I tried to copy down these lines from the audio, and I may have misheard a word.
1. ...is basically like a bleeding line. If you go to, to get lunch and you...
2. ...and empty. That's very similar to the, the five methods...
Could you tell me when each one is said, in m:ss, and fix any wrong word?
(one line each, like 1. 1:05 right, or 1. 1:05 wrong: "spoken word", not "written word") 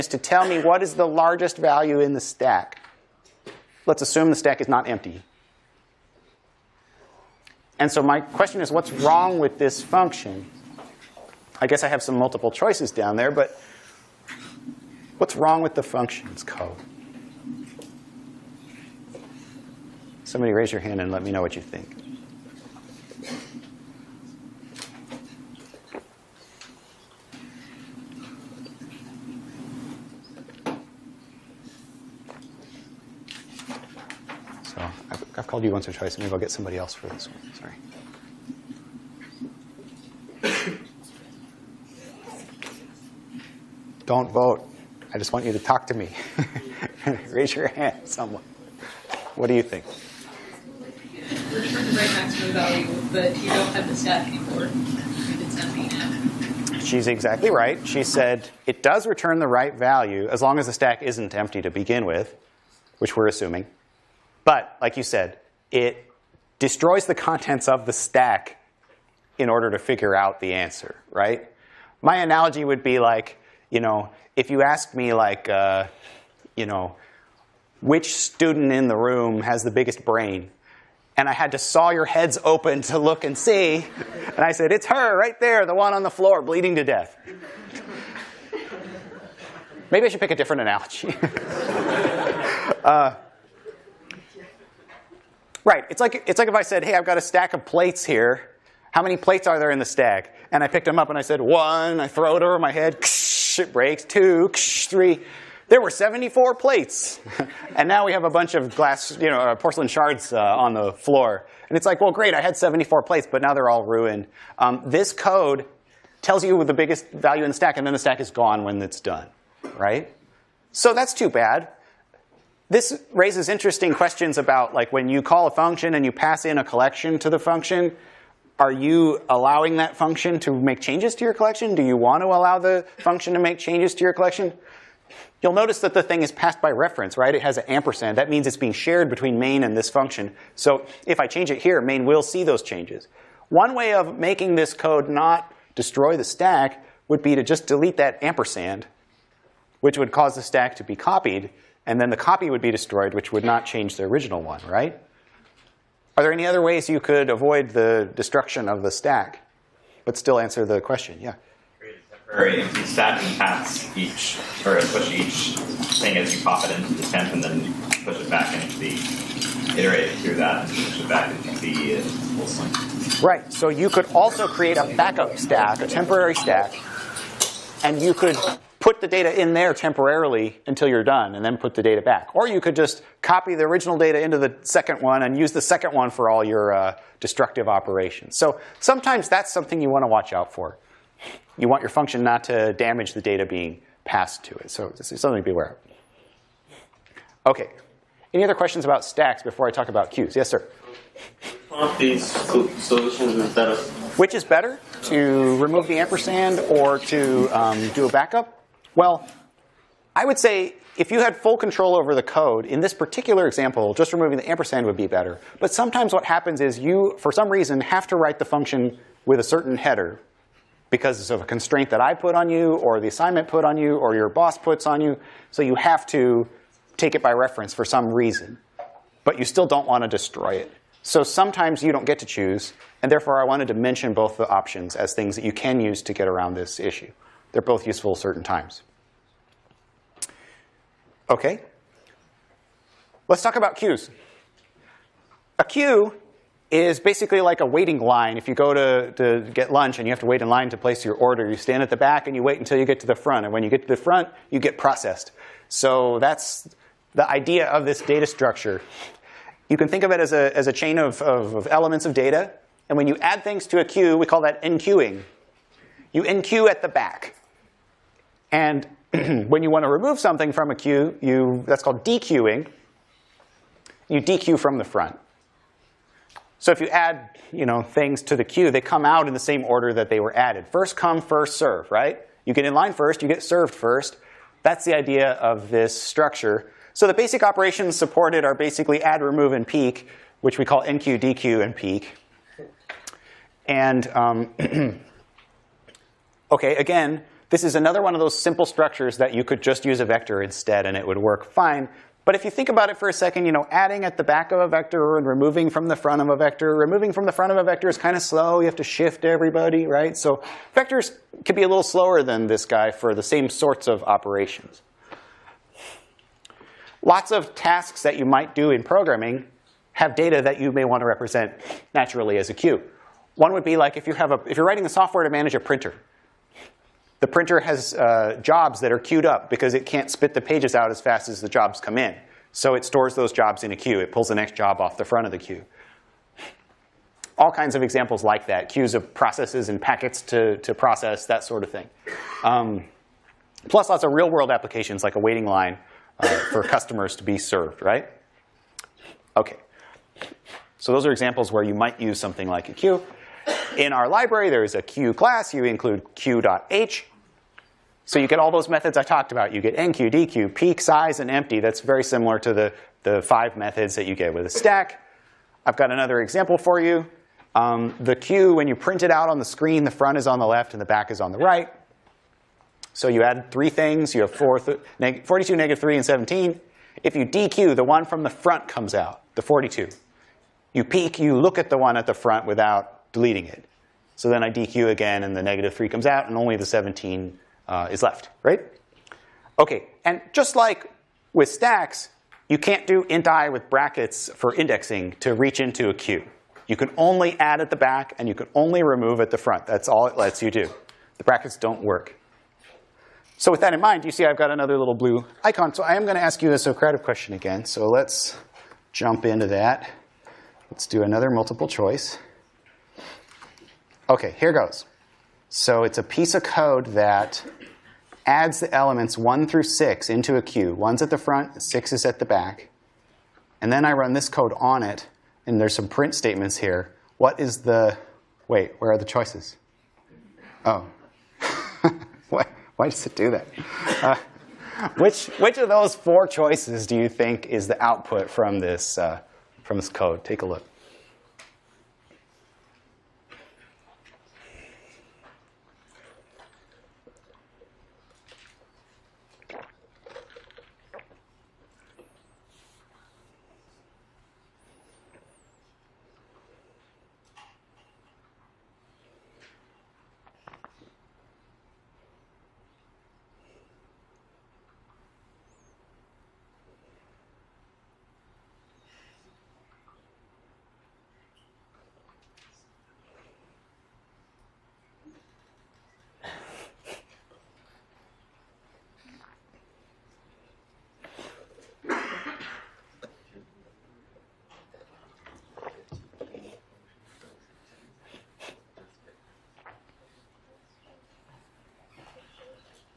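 1. 4:06 wrong: "waiting", not "bleeding"
2. 6:01 right.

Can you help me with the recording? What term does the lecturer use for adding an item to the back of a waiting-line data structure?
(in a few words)
enqueuing.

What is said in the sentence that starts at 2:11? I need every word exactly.
Do you want to allow the function to make changes to your collection?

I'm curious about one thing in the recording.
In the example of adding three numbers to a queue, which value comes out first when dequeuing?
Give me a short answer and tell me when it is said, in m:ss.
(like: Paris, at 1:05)
42, at 6:19.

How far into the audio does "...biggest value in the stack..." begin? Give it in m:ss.
1:56.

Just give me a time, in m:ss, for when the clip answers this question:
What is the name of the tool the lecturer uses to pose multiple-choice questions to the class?
6:46.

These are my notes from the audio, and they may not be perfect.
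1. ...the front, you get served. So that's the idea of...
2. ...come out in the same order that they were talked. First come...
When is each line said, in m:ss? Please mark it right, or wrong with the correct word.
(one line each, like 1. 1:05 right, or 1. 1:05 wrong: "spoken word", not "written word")
1. 4:13 wrong: "processed", not "served"
2. 4:38 wrong: "added", not "talked".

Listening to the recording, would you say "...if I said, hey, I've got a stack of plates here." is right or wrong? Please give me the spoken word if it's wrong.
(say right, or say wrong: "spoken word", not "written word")
right.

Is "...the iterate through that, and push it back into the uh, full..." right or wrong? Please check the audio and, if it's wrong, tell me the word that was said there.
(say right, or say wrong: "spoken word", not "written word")
right.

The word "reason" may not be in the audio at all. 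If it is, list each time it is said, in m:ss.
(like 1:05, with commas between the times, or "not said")
3:37, 3:48.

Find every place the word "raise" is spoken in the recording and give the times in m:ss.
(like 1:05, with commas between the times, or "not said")
0:20, 0:47, 2:03.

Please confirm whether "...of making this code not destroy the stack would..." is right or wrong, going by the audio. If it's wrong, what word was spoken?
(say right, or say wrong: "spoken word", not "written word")
right.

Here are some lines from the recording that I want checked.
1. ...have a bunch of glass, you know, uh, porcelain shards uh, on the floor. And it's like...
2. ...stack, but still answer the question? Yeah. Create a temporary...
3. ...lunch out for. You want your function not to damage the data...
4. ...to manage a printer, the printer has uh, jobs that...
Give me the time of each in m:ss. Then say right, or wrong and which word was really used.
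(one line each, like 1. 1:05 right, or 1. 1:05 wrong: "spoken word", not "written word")
1. 1:48 right
2. 2:38 right
3. 3:10 wrong: "watch", not "lunch"
4. 5:25 right.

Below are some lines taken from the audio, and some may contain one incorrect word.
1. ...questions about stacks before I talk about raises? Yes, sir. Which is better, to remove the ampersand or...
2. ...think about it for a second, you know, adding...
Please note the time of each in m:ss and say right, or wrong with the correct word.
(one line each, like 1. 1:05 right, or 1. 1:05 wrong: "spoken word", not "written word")
1. 3:18 wrong: "queues", not "raises"
2. 5:02 right.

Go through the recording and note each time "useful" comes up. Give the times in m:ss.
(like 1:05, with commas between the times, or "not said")
3:57.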